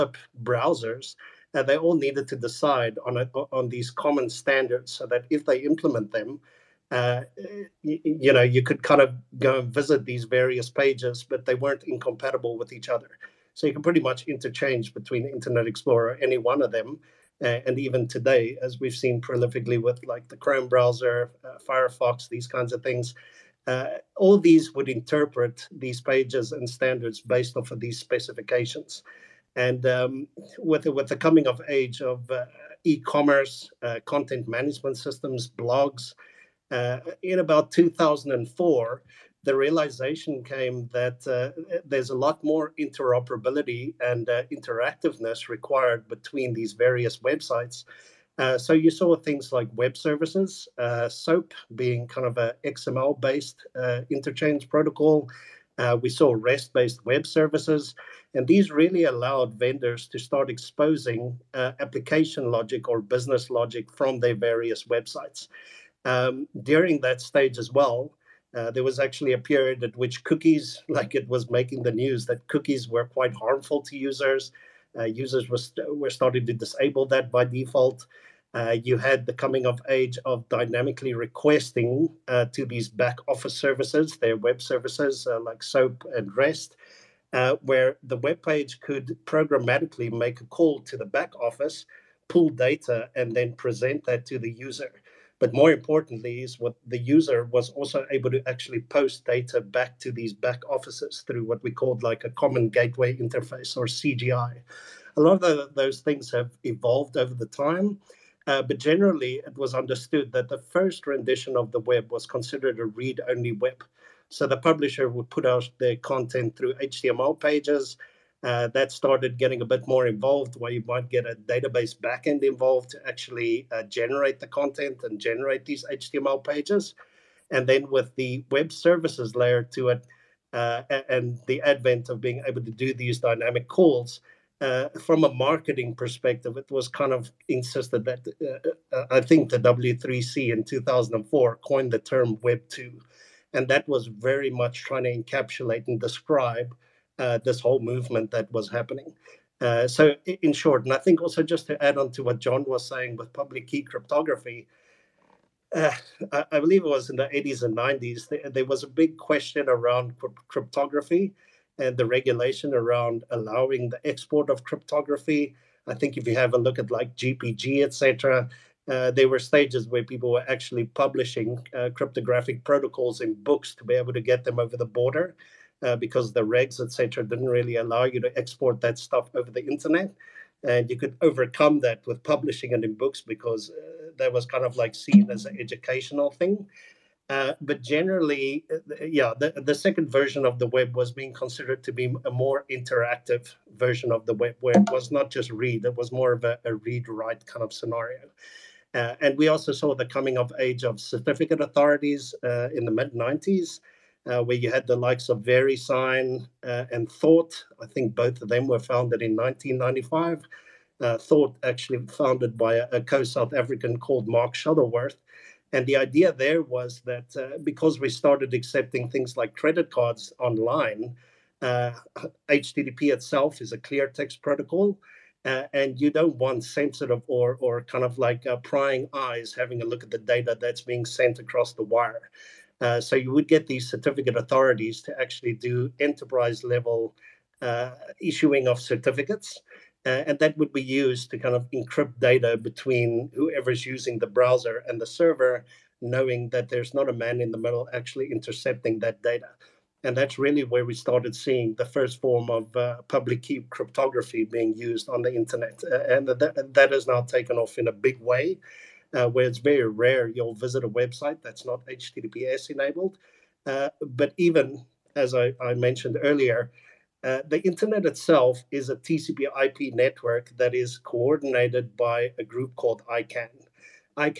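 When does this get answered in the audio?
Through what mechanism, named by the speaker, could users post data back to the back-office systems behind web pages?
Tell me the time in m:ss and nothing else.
1:42.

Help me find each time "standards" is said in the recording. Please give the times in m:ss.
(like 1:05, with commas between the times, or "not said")
0:04, 0:26.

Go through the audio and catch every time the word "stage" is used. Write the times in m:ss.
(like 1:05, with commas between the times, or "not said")
1:07, 2:49.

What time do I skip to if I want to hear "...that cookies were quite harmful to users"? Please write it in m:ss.
1:12.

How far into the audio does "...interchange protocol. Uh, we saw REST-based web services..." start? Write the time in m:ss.
0:54.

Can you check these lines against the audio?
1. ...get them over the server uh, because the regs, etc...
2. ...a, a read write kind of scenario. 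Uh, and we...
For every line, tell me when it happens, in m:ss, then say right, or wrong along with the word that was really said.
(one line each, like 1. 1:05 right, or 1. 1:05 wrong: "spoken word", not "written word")
1. 2:54 wrong: "border", not "server"
2. 3:16 right.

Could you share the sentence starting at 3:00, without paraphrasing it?
And you could overcome that with publishing it in books because uh, that was kind of like seen as an educational thing.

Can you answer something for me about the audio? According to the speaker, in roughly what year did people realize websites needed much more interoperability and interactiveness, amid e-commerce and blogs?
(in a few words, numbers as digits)
2004.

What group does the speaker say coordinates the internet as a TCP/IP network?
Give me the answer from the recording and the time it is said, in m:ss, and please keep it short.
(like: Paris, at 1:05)
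ICANN, at 4:33.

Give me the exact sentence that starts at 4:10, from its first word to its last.
And that's really where we started seeing the first form of uh, public key cryptography being used on the internet.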